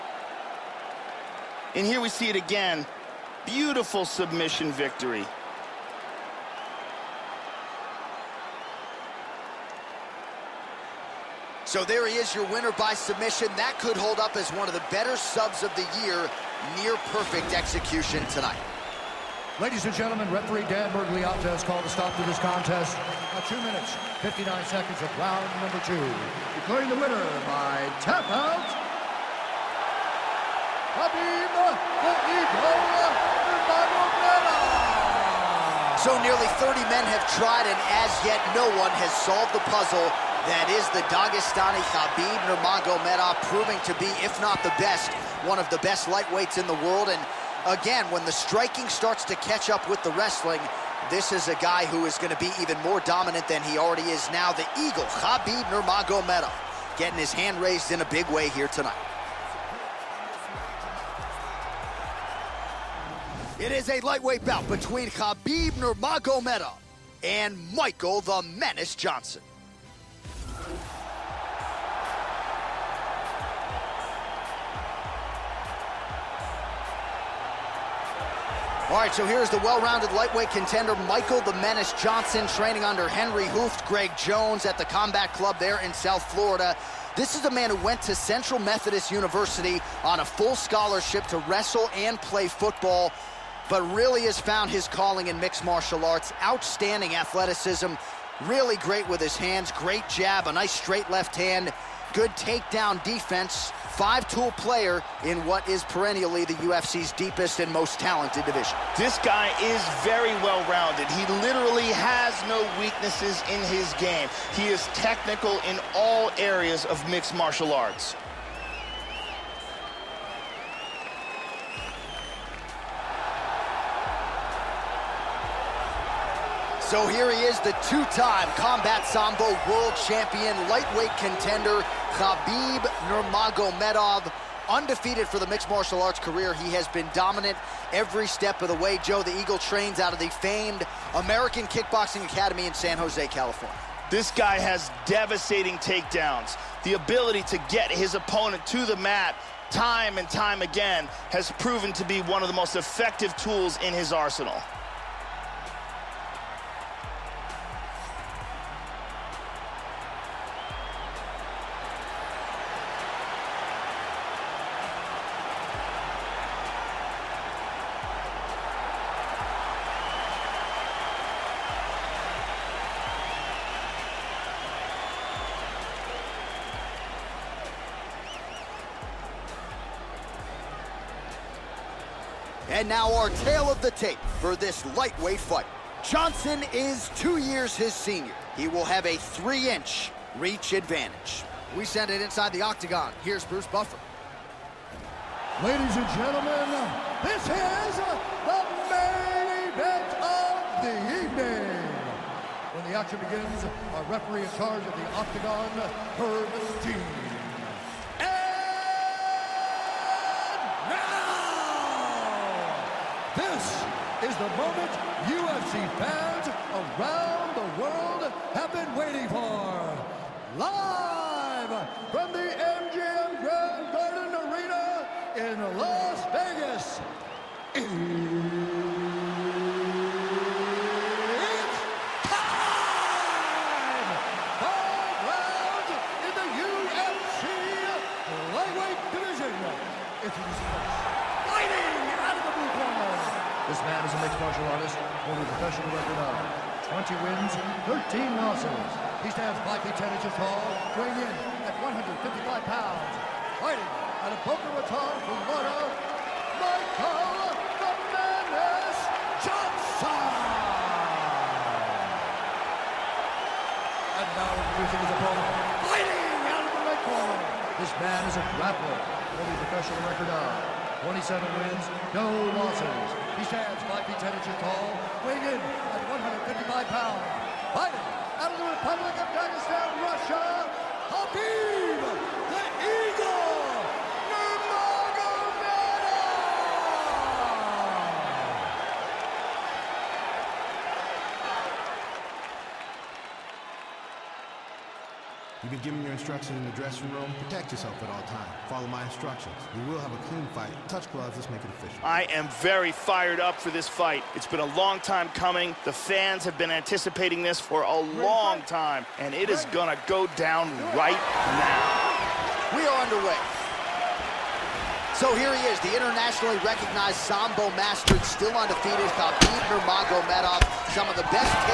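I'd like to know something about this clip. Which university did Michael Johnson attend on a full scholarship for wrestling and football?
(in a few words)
Central Methodist University.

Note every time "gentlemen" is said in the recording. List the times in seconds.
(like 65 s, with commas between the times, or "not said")
19 s, 196 s.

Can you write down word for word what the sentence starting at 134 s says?
Undefeated for the mixed martial arts career, he has been dominant every step of the way.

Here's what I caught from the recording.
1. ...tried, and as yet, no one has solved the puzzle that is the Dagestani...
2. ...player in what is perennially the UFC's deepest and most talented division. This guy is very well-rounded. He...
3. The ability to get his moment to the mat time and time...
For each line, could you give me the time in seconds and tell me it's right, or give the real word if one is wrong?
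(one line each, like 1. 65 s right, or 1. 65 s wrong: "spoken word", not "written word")
1. 37 s right
2. 104 s right
3. 146 s wrong: "opponent", not "moment".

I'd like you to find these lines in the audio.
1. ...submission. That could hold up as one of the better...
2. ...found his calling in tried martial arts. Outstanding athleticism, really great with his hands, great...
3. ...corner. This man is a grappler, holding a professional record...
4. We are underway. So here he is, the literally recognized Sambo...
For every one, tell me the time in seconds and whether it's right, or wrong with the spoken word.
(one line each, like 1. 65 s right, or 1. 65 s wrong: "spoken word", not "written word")
1. 12 s right
2. 94 s wrong: "mixed", not "tried"
3. 267 s right
4. 312 s wrong: "internationally", not "literally".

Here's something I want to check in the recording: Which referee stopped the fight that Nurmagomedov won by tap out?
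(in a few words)
Dan Miragliotta.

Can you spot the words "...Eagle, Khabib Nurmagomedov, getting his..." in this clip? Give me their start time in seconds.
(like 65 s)
54 s.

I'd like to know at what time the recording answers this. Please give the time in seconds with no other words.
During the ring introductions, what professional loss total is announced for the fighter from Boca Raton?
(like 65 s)
247 s.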